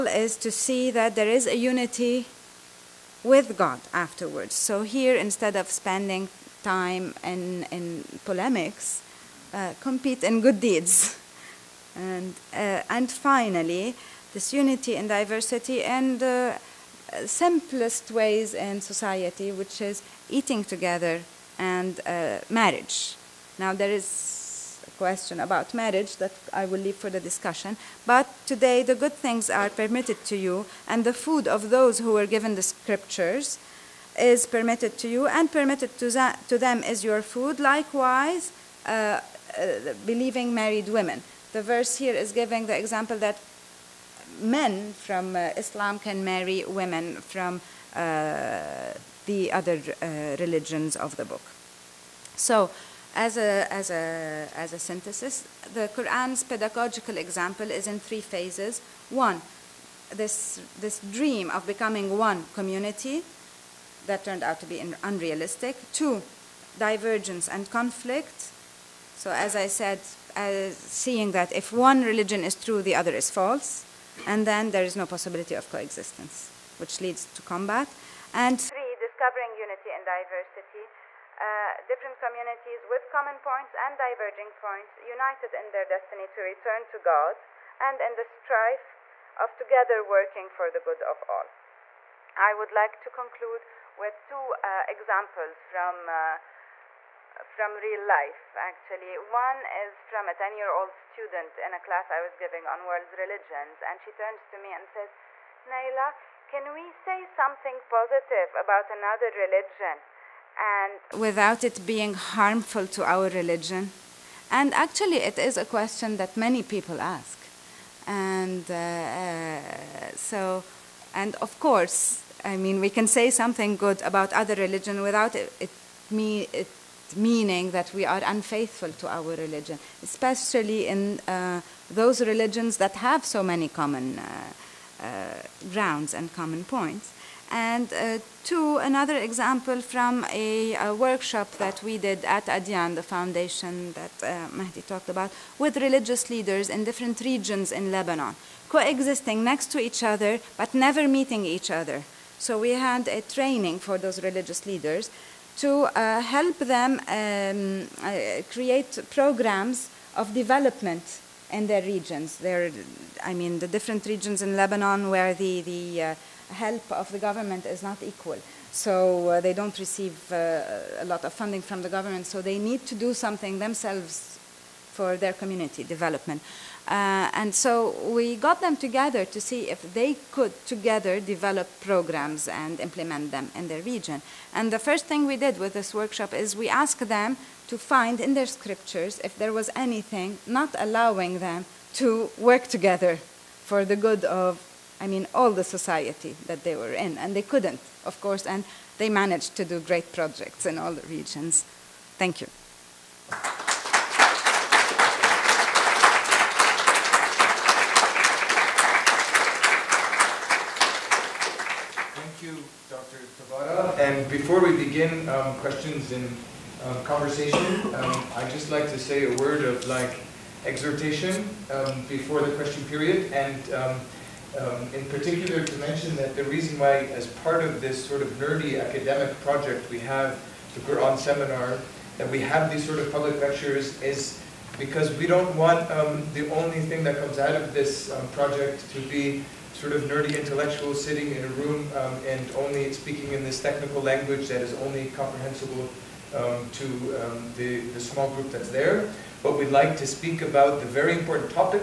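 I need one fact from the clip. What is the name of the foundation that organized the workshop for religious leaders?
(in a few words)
Adyan.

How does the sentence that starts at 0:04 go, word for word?
So here, instead of spending time in, in polemics, uh, compete in good deeds.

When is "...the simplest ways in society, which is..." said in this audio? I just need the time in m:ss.
0:16.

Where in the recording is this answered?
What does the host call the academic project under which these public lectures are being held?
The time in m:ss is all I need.
3:50.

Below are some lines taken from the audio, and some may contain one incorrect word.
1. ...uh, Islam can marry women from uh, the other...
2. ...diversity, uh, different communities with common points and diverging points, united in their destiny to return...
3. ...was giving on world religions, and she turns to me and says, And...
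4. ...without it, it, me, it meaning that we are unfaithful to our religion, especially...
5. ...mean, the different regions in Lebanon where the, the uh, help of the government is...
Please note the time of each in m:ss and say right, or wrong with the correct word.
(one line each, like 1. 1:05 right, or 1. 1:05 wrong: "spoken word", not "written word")
1. 0:45 right
2. 1:20 right
3. 1:42 wrong: "Nayla", not "And"
4. 2:05 right
5. 2:43 right.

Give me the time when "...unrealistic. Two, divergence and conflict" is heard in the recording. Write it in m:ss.
1:05.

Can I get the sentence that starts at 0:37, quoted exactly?
Likewise, uh, uh, believing married women.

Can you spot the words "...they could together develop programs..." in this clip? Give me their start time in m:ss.
2:59.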